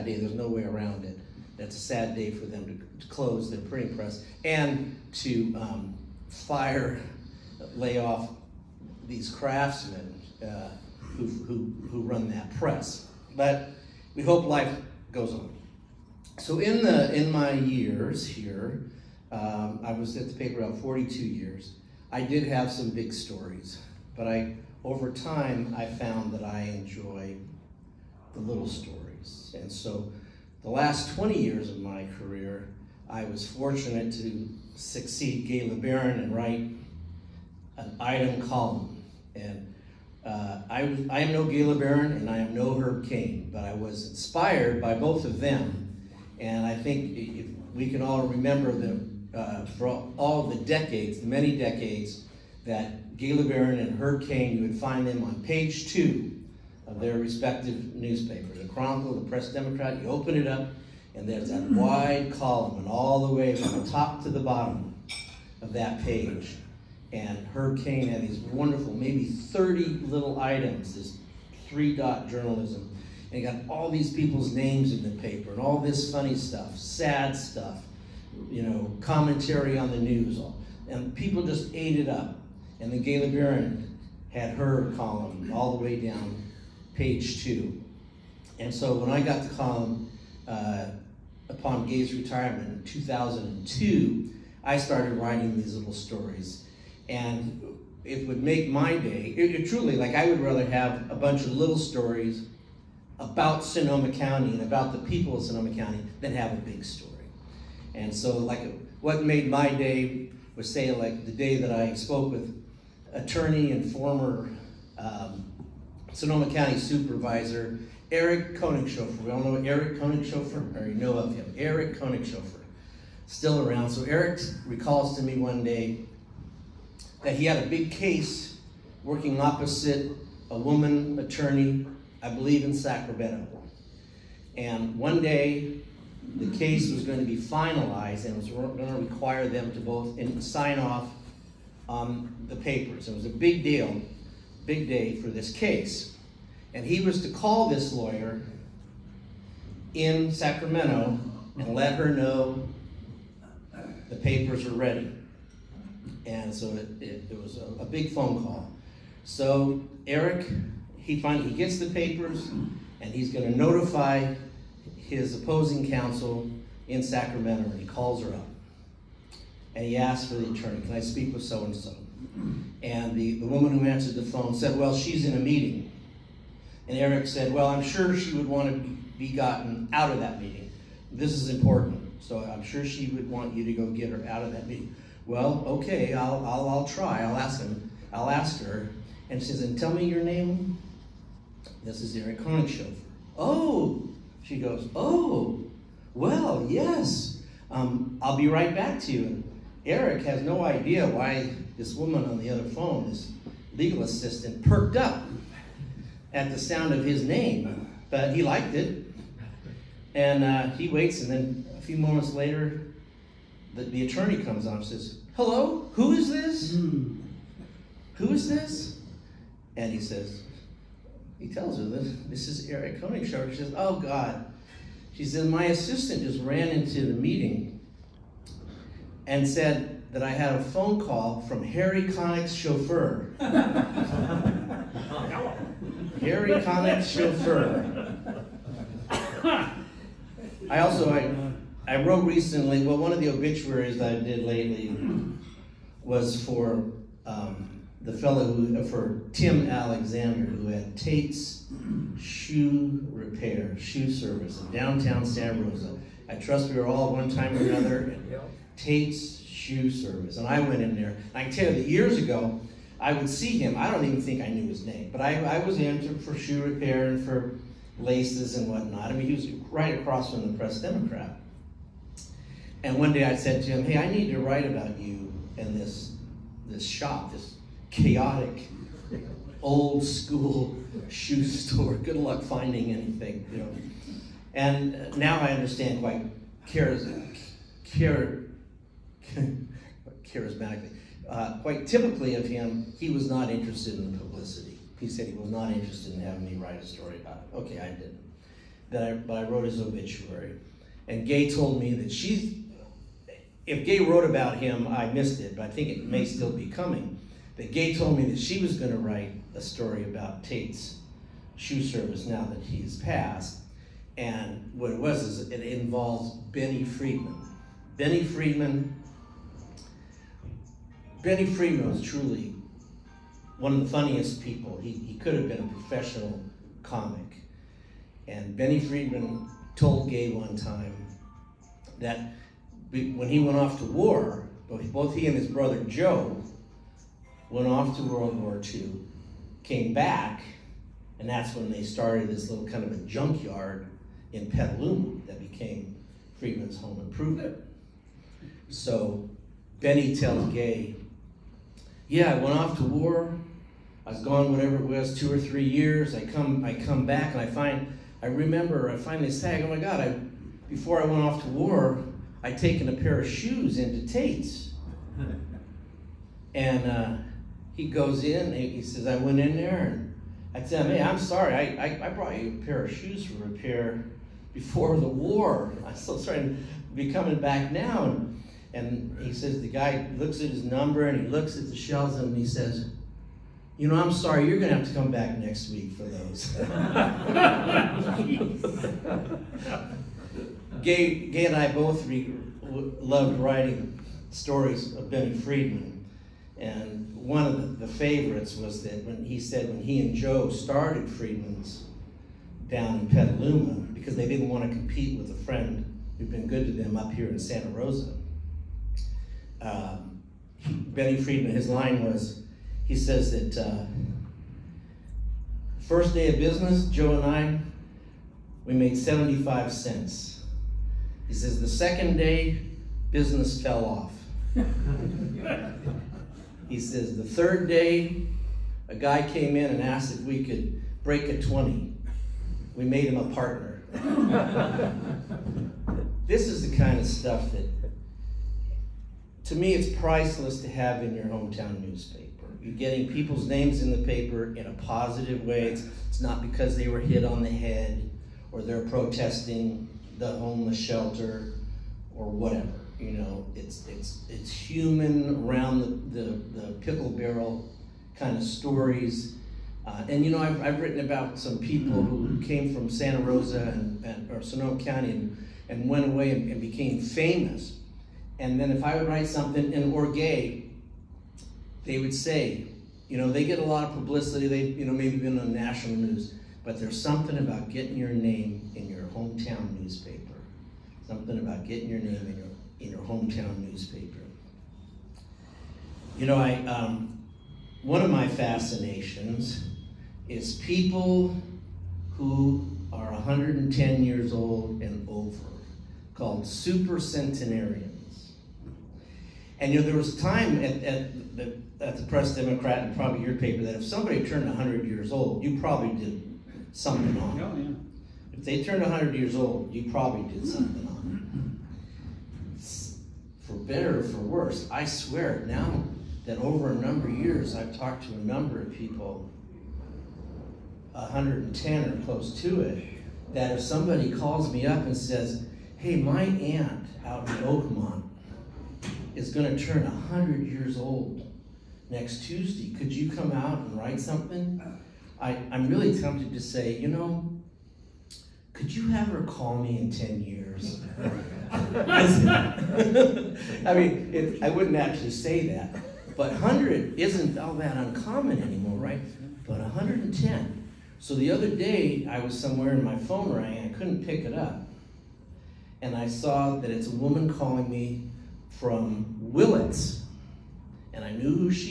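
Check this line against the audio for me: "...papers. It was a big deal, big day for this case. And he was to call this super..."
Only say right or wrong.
wrong.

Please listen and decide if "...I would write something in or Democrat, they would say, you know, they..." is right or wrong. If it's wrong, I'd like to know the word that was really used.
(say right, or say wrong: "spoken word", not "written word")
wrong: "Gaye", not "Democrat".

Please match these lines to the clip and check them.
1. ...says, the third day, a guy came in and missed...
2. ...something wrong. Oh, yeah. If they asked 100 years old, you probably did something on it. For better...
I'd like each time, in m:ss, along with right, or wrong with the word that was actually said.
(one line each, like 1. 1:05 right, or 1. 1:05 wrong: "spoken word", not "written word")
1. 7:06 wrong: "asked", not "missed"
2. 8:26 wrong: "turned", not "asked".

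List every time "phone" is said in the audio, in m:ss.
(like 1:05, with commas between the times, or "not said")
2:38, 2:54, 3:22, 3:50, 9:12.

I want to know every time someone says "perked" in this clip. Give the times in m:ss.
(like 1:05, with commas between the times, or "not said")
3:24.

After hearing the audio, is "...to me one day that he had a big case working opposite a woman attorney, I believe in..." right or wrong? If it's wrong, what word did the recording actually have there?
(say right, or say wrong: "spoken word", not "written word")
right.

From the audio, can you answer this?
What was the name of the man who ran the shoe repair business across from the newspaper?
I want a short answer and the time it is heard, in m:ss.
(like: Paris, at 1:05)
Tim Alexander, at 4:09.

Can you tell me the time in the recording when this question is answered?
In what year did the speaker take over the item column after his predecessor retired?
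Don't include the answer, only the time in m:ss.
1:32.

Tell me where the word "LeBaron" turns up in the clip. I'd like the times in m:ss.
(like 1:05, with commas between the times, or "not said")
0:35, 0:41, 0:53, 1:23.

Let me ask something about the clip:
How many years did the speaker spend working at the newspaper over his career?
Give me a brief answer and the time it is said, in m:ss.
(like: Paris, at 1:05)
42, at 0:20.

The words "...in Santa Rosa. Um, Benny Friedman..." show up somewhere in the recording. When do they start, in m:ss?
6:47.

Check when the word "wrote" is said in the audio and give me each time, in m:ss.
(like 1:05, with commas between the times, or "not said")
4:02, 4:59, 5:04.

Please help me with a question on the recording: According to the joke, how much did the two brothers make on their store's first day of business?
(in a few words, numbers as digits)
75 cents.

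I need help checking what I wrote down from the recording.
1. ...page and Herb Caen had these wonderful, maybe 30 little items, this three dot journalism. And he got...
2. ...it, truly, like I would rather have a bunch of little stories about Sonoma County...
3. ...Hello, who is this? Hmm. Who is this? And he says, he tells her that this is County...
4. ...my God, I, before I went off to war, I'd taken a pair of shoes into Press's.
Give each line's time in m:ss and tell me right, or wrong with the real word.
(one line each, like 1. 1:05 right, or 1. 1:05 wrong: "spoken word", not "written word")
1. 1:06 right
2. 1:39 right
3. 3:35 wrong: "Eric", not "County"
4. 5:59 wrong: "Tate", not "Press".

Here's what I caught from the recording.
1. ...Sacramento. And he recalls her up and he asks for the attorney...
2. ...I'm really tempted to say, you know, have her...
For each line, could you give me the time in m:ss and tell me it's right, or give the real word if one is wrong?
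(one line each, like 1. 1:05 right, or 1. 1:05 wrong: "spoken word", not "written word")
1. 2:47 wrong: "calls", not "recalls"
2. 8:55 right.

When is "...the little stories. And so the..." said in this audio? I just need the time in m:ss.
0:28.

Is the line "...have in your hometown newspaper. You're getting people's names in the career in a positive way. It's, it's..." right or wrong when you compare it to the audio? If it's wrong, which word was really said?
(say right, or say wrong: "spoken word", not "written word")
wrong: "paper", not "career".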